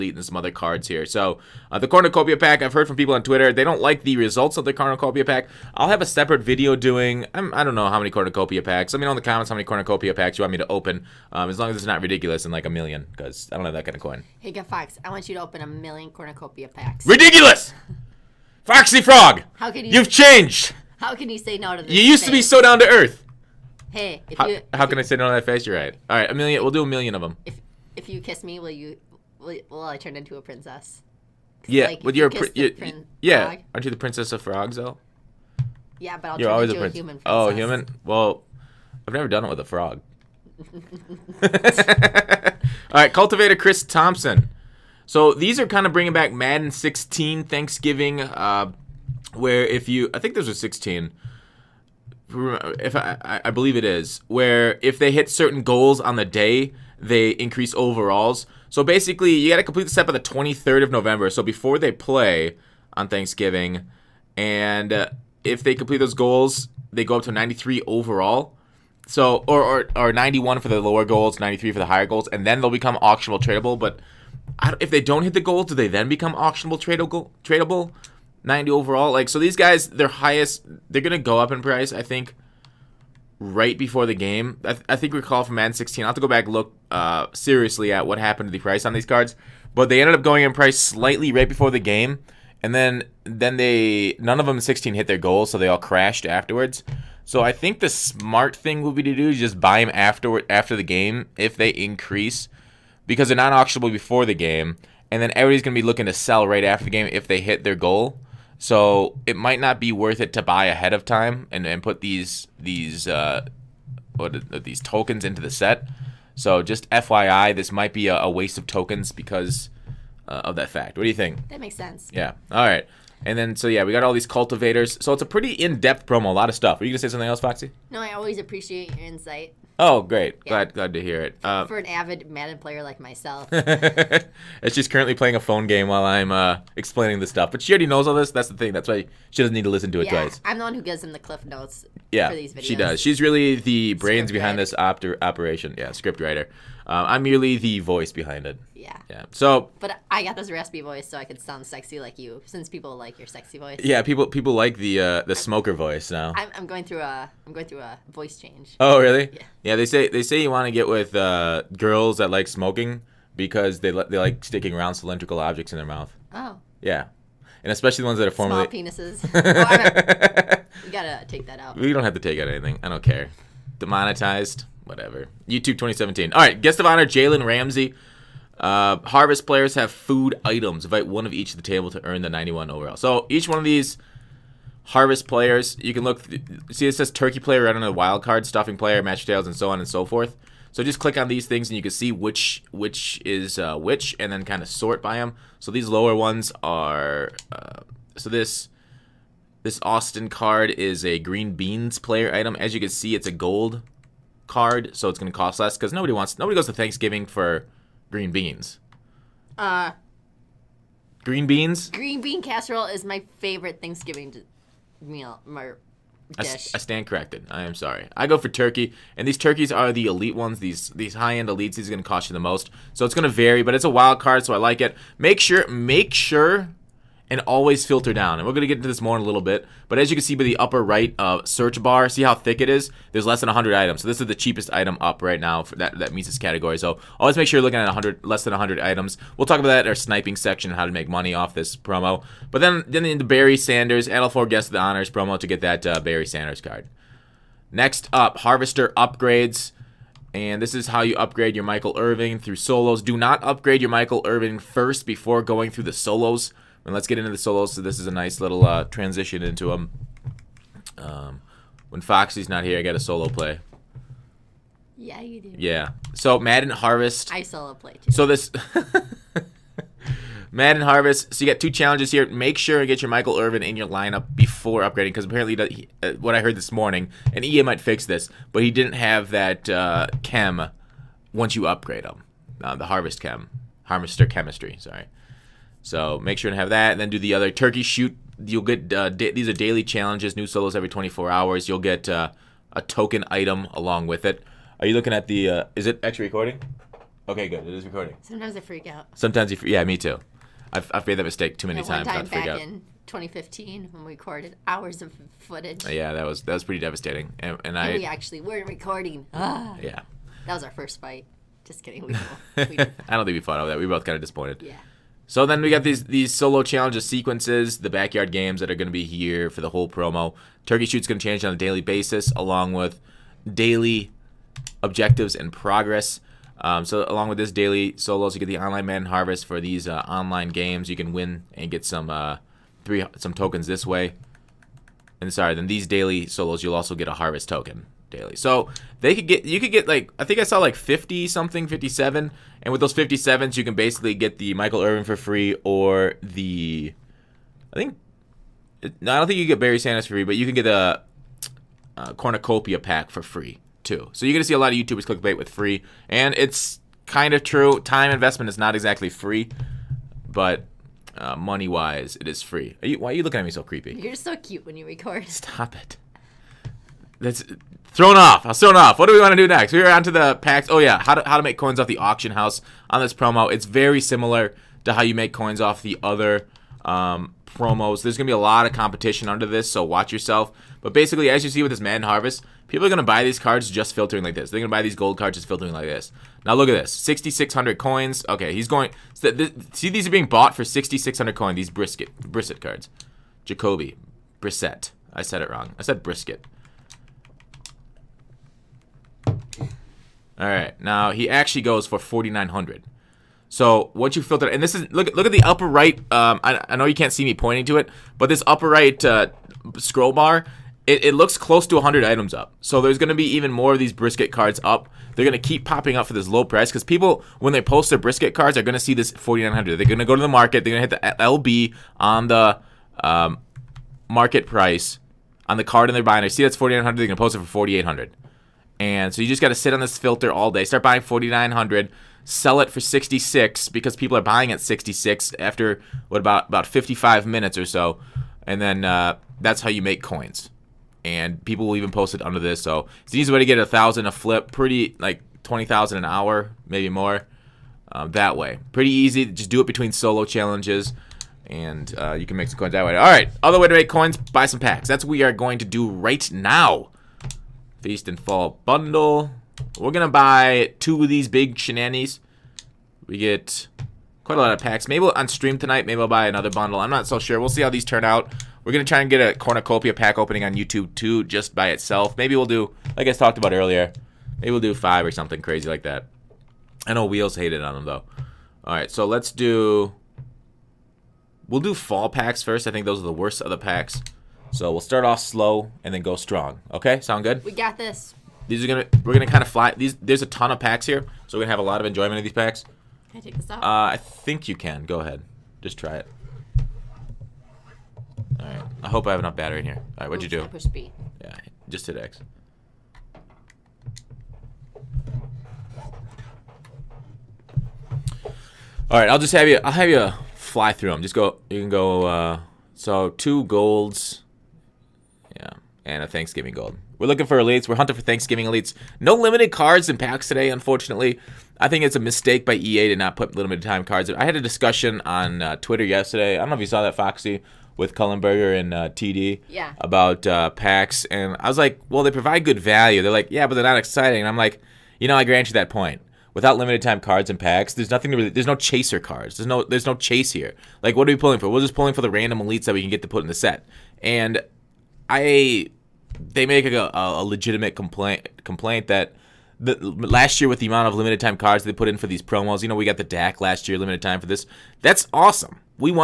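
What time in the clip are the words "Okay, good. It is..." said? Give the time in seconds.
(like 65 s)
297 s.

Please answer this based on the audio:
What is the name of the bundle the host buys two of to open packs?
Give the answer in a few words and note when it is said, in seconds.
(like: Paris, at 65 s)
Feast and Fall bundle, at 457 s.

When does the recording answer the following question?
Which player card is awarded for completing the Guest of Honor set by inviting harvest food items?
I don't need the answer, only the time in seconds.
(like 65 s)
177 s.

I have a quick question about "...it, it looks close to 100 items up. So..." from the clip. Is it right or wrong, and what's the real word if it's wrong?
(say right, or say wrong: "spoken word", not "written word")
right.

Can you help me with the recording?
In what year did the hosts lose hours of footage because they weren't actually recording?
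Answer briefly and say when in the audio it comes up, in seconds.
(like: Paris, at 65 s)
2015, at 303 s.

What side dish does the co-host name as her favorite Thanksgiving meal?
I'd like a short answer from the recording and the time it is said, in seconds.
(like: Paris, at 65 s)
Green bean casserole, at 211 s.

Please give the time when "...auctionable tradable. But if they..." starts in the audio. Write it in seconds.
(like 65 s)
73 s.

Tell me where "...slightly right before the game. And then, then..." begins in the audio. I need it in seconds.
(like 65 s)
90 s.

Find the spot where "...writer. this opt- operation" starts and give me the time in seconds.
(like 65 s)
144 s.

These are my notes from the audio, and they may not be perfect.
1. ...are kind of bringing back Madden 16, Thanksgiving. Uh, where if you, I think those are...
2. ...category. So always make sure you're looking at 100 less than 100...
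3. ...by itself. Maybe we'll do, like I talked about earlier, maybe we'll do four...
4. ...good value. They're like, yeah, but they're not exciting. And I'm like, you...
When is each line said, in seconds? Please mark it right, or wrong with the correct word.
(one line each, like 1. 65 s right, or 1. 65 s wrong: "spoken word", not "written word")
1. 45 s right
2. 236 s right
3. 471 s wrong: "five", not "four"
4. 532 s right.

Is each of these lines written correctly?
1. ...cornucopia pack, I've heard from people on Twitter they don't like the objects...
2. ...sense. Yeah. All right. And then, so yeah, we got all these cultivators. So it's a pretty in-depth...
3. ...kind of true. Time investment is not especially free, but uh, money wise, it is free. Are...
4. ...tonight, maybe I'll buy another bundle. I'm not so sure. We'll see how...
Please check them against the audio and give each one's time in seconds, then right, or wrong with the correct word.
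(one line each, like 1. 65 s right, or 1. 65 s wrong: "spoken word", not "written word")
1. 1 s wrong: "results", not "objects"
2. 121 s right
3. 357 s wrong: "exactly", not "especially"
4. 465 s right.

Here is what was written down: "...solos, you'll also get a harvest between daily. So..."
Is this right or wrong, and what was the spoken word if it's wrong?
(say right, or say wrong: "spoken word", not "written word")
wrong: "token", not "between".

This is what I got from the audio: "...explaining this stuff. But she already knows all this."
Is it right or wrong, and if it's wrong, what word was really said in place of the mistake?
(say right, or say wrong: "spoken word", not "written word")
right.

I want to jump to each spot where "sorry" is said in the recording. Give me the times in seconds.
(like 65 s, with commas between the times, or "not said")
217 s, 284 s, 335 s.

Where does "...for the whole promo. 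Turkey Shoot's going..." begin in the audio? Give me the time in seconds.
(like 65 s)
319 s.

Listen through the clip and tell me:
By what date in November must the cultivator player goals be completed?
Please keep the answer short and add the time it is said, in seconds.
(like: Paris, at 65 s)
23rd, at 60 s.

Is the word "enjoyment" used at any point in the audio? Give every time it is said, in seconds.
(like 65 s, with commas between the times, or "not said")
491 s.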